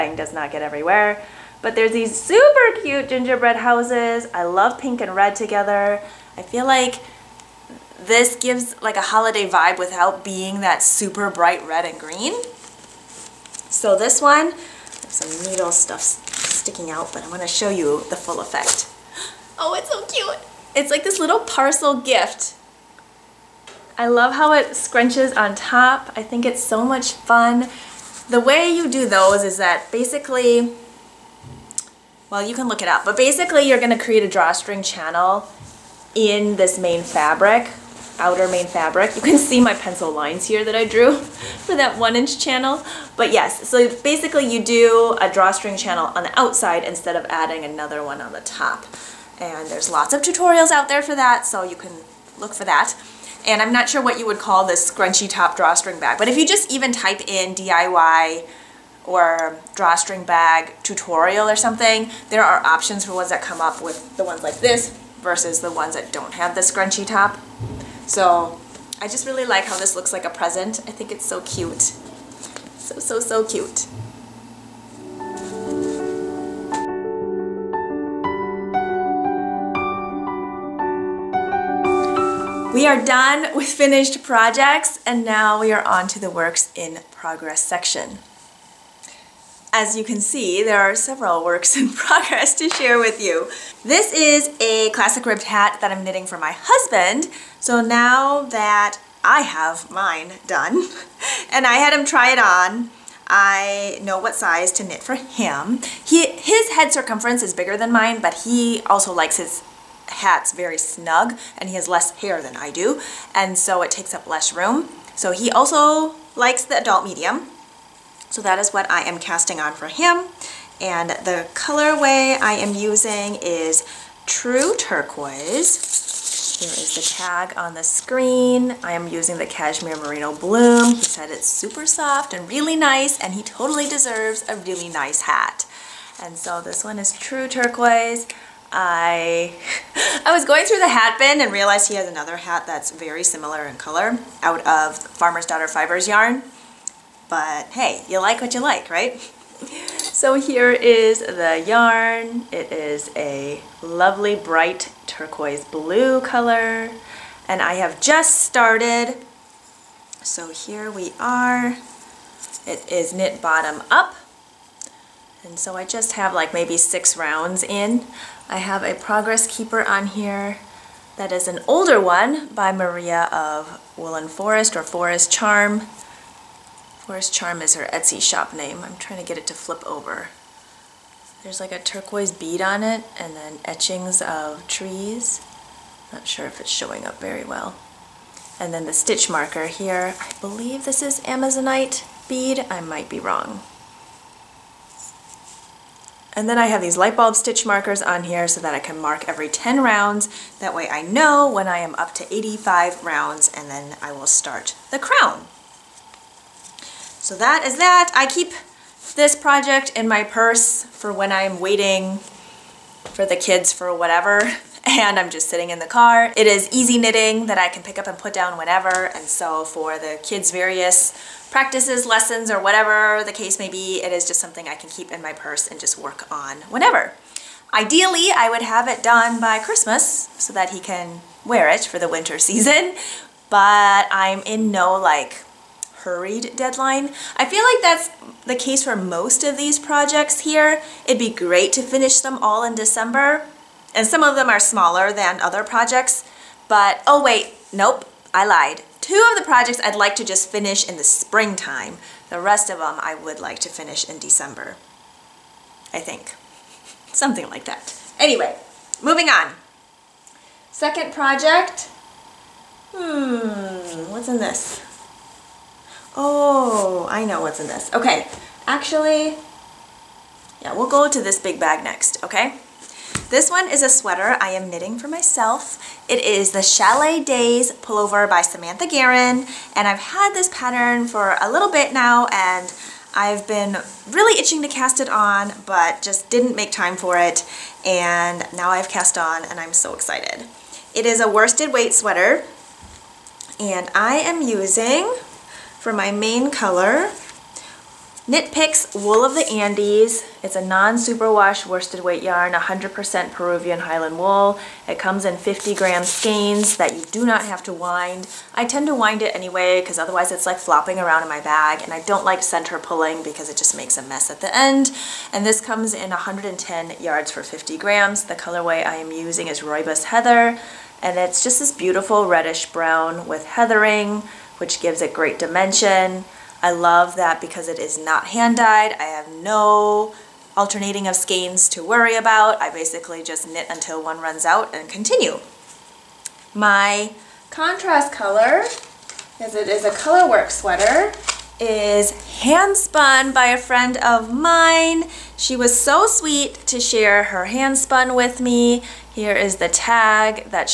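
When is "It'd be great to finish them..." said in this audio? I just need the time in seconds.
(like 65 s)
241 s.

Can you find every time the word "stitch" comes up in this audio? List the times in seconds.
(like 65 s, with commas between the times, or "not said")
188 s, 197 s.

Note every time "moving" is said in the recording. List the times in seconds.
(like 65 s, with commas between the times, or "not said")
259 s.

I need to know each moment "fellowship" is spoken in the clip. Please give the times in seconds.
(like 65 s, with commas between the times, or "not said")
not said.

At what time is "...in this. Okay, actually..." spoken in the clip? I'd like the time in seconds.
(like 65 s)
267 s.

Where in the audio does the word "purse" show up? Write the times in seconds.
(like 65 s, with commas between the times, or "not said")
210 s, 225 s.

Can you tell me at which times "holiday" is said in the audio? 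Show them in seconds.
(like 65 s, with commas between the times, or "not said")
9 s.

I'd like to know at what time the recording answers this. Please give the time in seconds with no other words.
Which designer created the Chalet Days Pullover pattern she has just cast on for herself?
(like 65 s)
278 s.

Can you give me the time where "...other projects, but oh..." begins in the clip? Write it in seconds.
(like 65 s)
245 s.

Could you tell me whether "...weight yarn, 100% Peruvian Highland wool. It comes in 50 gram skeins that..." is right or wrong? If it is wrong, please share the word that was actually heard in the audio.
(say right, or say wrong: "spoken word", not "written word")
right.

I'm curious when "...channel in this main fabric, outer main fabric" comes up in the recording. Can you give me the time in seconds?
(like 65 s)
34 s.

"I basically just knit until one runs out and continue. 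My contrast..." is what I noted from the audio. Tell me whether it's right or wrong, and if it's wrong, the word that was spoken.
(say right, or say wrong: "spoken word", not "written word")
right.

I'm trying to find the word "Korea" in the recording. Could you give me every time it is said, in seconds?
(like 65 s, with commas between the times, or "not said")
not said.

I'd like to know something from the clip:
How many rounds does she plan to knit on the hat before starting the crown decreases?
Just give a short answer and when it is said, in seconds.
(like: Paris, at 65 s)
85, at 202 s.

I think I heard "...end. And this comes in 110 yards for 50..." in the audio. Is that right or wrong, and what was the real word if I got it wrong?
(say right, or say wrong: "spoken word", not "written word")
right.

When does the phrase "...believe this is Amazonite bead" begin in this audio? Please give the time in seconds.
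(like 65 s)
190 s.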